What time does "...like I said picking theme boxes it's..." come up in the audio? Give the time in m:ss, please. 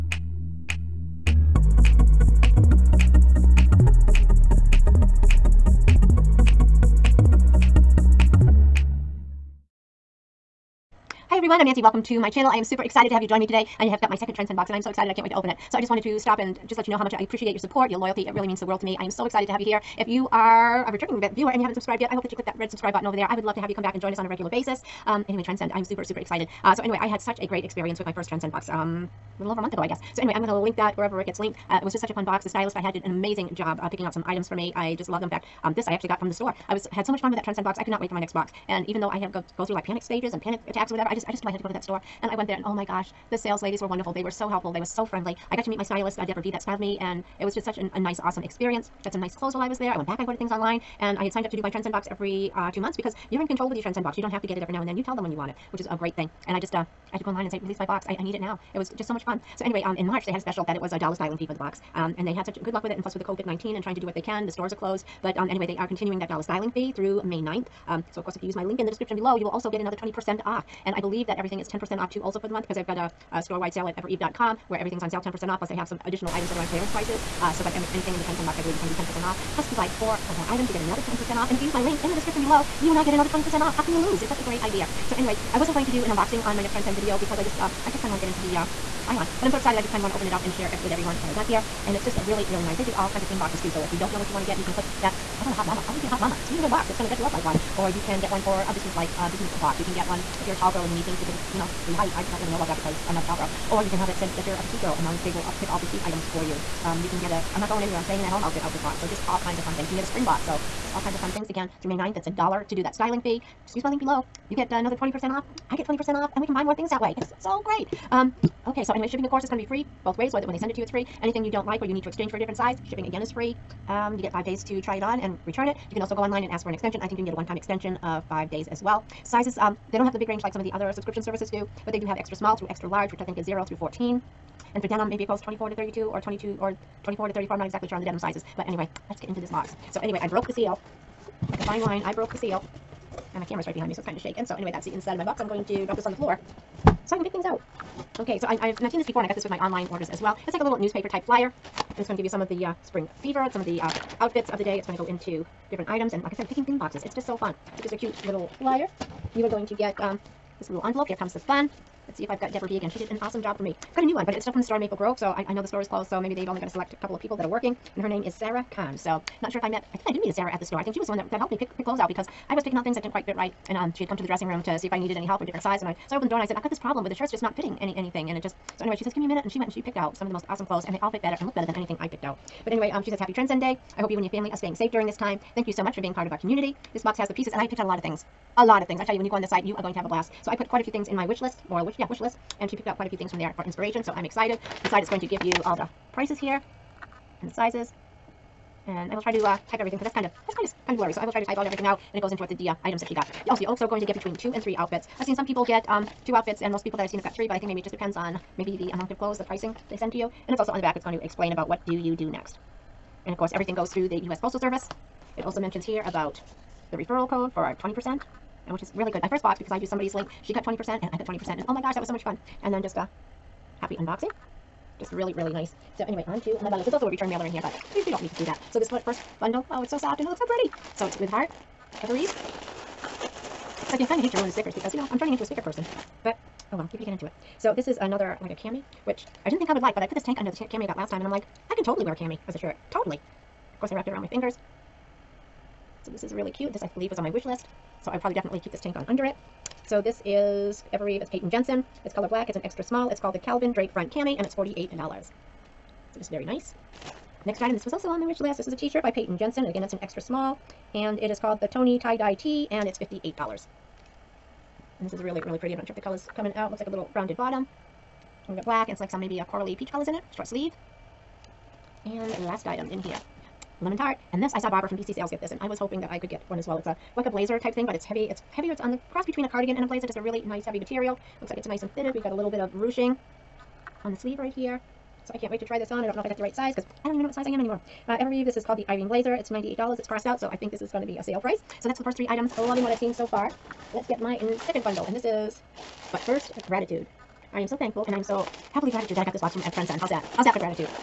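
2:36.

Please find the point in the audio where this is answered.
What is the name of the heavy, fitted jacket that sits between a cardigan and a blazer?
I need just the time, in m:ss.
4:48.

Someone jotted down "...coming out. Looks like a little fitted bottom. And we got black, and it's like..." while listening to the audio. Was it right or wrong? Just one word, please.
wrong.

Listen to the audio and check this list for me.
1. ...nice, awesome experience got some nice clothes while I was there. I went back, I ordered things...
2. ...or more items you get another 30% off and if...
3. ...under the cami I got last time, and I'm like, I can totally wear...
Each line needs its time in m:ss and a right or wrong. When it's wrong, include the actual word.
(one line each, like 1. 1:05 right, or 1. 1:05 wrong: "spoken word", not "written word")
1. 0:47 right
2. 1:20 wrong: "10", not "30"
3. 4:00 right.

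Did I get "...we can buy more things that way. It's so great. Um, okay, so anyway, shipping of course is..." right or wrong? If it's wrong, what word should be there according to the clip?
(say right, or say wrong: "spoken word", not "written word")
right.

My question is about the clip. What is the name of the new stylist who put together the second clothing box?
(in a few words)
Sarah Khan.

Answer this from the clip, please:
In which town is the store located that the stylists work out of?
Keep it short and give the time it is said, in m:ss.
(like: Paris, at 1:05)
Maple Grove, at 2:44.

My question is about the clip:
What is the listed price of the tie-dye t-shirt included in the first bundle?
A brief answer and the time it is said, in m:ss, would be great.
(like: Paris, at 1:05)
$58, at 4:23.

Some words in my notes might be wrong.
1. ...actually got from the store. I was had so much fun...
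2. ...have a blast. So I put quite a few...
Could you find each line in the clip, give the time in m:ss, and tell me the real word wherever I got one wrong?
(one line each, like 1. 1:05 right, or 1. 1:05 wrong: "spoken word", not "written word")
1. 0:35 right
2. 3:09 right.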